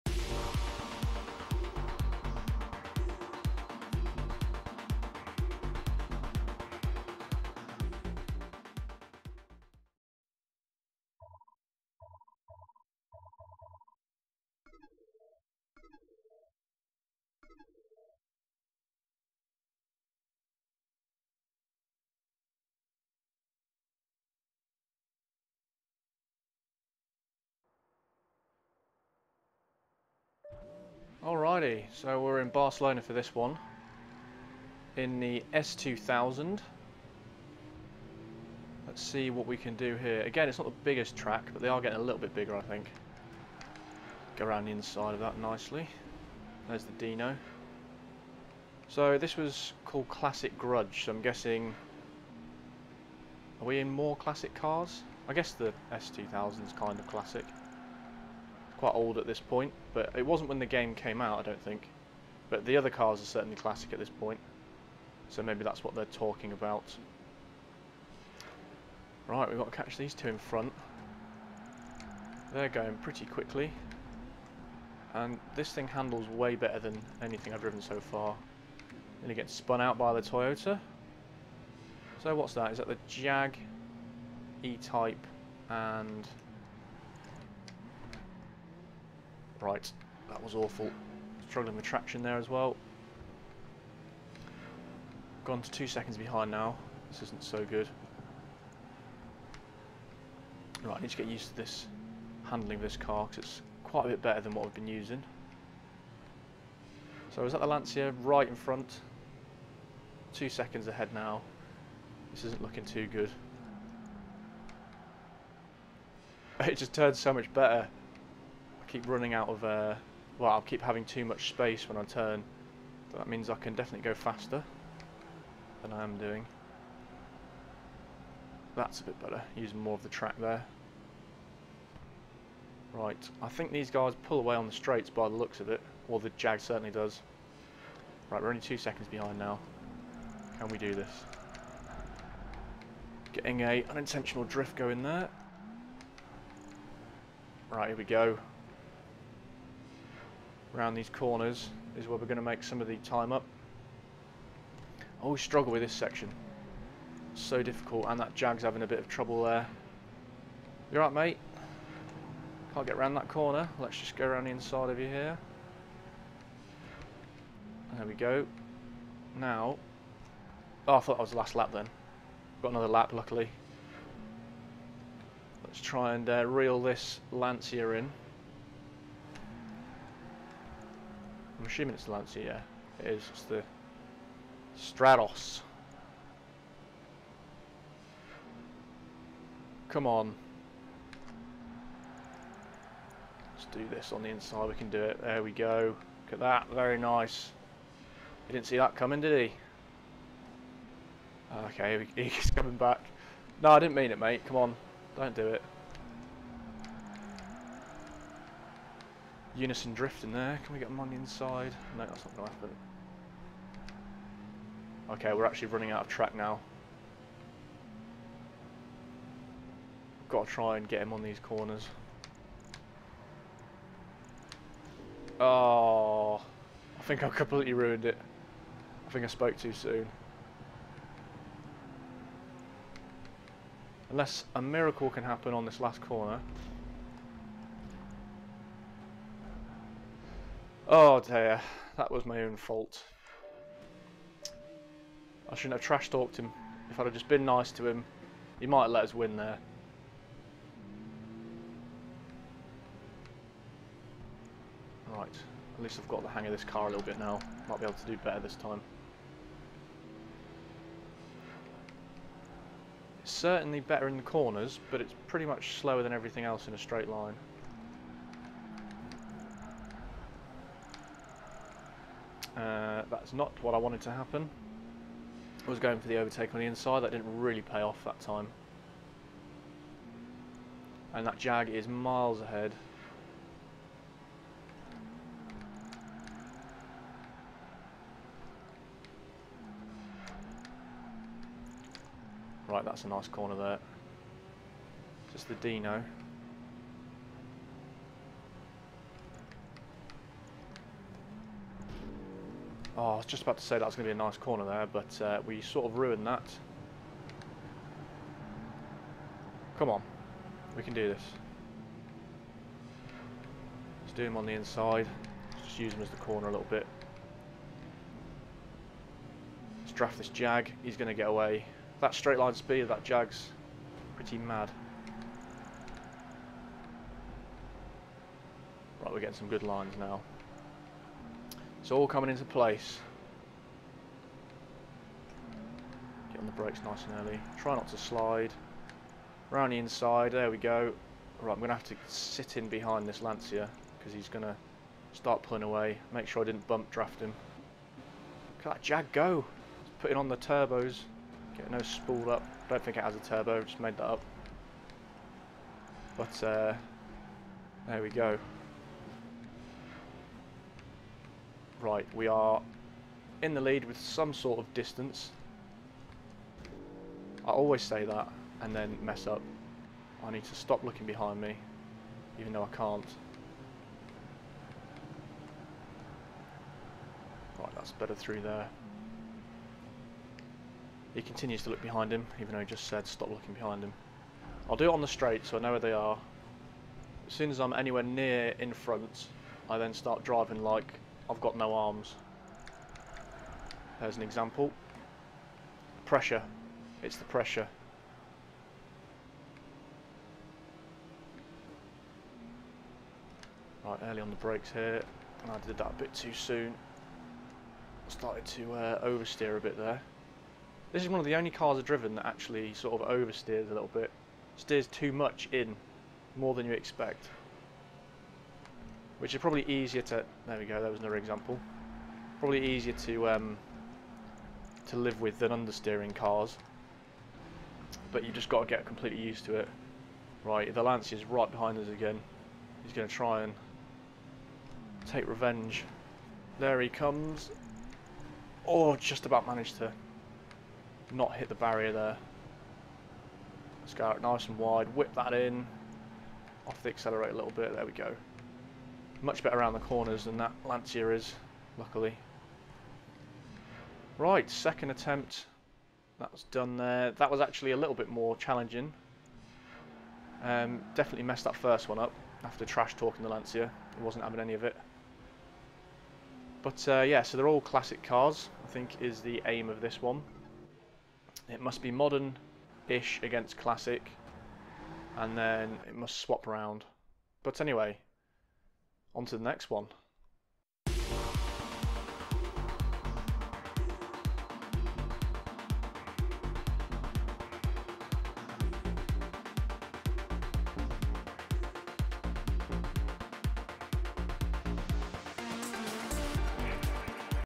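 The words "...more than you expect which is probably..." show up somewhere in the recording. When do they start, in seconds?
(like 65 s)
416 s.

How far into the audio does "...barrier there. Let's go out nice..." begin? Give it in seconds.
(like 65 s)
441 s.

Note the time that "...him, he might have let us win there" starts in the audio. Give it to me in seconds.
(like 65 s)
247 s.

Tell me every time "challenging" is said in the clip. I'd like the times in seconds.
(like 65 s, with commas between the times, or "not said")
458 s.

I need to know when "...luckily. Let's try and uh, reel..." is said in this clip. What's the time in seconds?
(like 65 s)
173 s.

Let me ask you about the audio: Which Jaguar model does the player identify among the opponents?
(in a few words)
E-Type.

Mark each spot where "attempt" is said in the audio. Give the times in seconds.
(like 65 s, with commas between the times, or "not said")
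454 s.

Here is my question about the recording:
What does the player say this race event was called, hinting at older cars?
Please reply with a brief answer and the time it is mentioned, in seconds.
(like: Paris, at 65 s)
Classic Grudge, at 50 s.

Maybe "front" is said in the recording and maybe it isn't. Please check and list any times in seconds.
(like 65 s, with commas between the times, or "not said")
70 s, 108 s, 388 s.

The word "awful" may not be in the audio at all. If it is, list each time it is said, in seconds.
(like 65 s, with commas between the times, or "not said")
90 s.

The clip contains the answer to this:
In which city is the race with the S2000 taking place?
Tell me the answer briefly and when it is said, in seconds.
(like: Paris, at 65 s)
Barcelona, at 32 s.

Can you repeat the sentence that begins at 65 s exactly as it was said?
So maybe that's what they're talking about.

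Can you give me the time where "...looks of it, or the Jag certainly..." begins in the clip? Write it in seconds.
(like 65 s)
135 s.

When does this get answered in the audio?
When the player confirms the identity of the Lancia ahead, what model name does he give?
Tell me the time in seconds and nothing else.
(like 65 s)
184 s.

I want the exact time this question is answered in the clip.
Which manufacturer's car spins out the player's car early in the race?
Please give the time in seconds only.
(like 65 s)
80 s.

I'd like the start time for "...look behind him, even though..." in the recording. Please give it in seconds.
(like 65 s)
381 s.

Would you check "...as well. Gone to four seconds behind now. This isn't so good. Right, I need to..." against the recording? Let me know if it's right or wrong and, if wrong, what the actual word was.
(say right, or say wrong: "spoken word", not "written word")
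wrong: "two", not "four".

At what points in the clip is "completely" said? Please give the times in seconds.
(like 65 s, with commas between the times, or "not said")
227 s, 428 s.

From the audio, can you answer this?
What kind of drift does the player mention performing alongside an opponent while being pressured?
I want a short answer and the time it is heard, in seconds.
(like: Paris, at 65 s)
Unison Drift, at 209 s.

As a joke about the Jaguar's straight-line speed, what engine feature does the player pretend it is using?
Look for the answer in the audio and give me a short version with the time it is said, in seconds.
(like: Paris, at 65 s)
turbos, at 350 s.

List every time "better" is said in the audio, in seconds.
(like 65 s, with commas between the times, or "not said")
76 s, 104 s, 117 s, 129 s, 258 s, 263 s, 377 s, 449 s.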